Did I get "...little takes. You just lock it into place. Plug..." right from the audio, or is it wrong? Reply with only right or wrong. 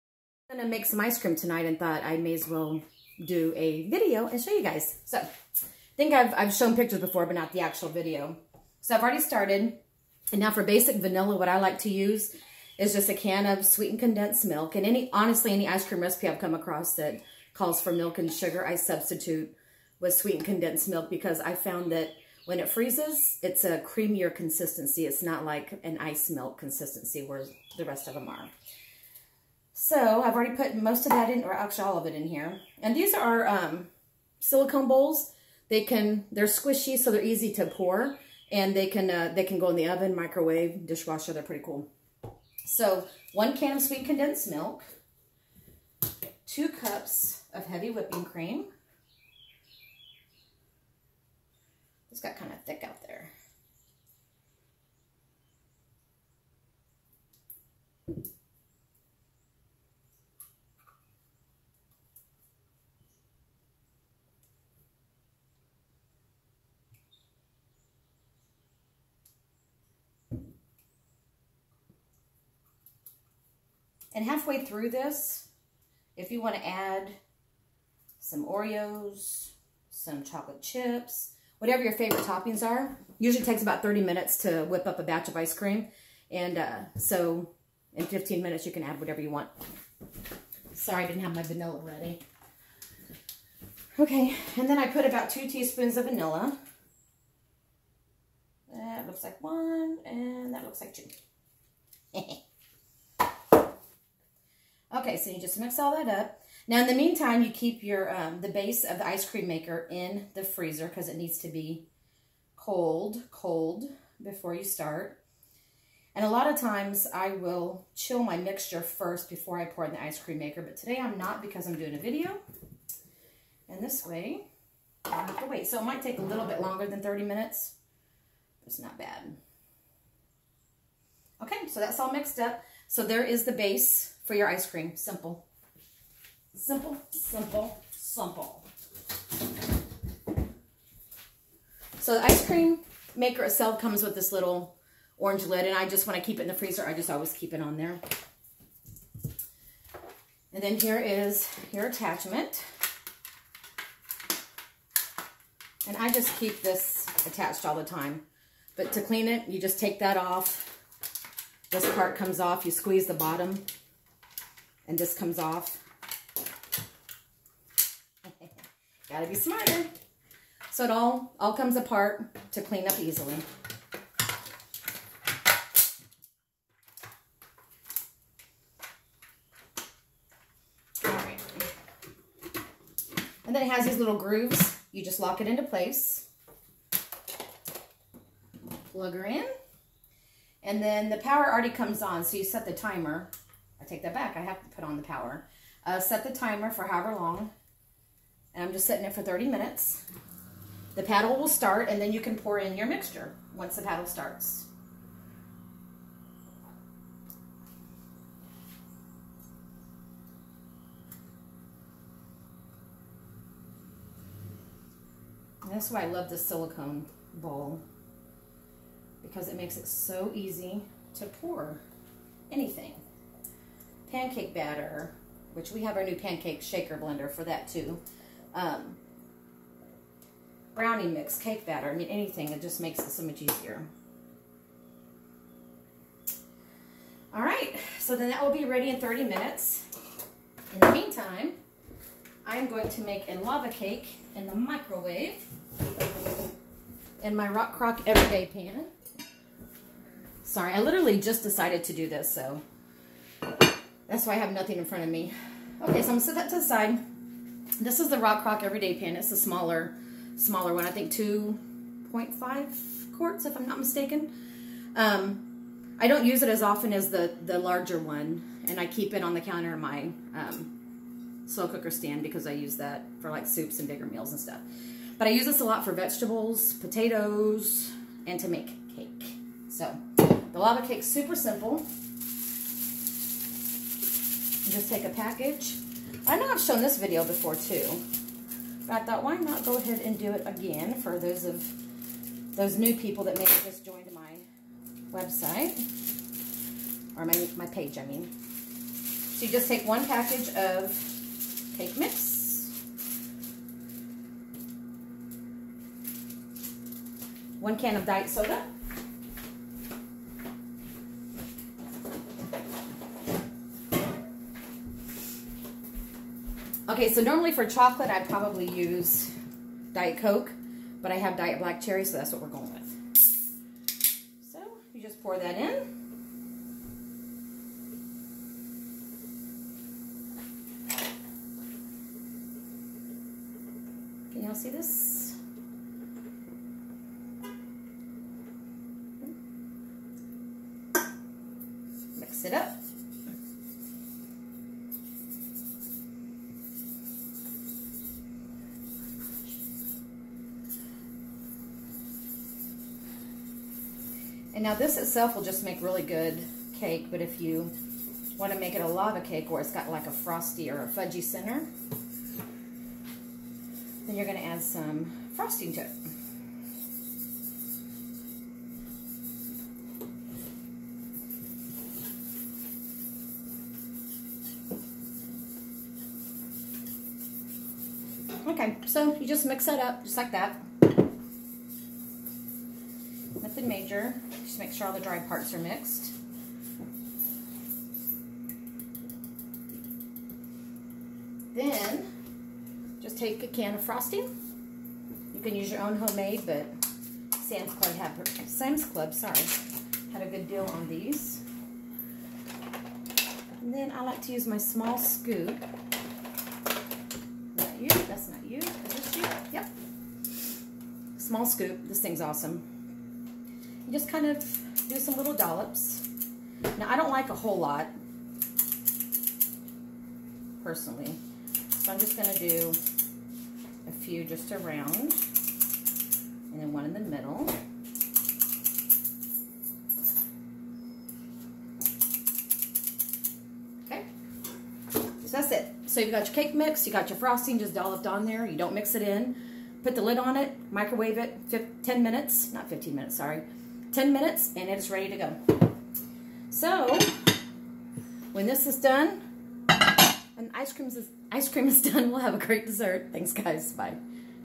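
wrong.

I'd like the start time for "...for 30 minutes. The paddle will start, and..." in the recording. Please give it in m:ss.
3:19.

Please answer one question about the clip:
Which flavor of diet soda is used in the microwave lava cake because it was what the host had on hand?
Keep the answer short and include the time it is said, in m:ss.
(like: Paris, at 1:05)
Diet Black Cherry, at 5:21.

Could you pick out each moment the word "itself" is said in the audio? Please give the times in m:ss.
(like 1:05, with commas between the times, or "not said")
2:23, 5:54.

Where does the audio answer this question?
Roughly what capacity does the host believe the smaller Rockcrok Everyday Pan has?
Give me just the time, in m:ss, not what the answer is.
4:21.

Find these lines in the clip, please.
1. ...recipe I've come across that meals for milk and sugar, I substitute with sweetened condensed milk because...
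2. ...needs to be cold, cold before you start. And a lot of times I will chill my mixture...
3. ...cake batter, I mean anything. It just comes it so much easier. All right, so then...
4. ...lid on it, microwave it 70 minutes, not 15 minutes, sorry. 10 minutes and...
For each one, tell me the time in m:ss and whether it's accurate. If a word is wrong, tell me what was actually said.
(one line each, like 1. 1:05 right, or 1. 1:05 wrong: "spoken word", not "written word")
1. 0:16 wrong: "calls", not "meals"
2. 1:51 right
3. 3:51 wrong: "makes", not "comes"
4. 7:20 wrong: "10", not "70".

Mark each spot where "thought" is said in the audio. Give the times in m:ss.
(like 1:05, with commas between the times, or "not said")
0:01, 4:48.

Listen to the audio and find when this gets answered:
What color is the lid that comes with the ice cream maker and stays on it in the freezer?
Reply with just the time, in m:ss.
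2:25.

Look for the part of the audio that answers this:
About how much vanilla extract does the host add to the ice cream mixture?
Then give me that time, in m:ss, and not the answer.
1:35.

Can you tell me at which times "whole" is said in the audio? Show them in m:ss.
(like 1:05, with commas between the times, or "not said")
6:57.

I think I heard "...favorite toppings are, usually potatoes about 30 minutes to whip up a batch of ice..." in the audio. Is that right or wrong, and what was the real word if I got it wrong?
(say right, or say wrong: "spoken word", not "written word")
wrong: "takes", not "potatoes".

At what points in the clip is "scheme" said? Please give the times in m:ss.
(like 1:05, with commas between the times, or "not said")
not said.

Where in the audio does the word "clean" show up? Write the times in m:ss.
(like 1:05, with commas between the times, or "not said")
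2:39, 2:52.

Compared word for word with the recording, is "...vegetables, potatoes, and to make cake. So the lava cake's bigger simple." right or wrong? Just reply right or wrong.
wrong.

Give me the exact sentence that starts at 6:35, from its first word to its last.
You can use your own homemade, but Sam's Club had Sam's Club, sorry, had a good deal on these.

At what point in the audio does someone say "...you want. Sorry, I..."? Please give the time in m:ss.
1:29.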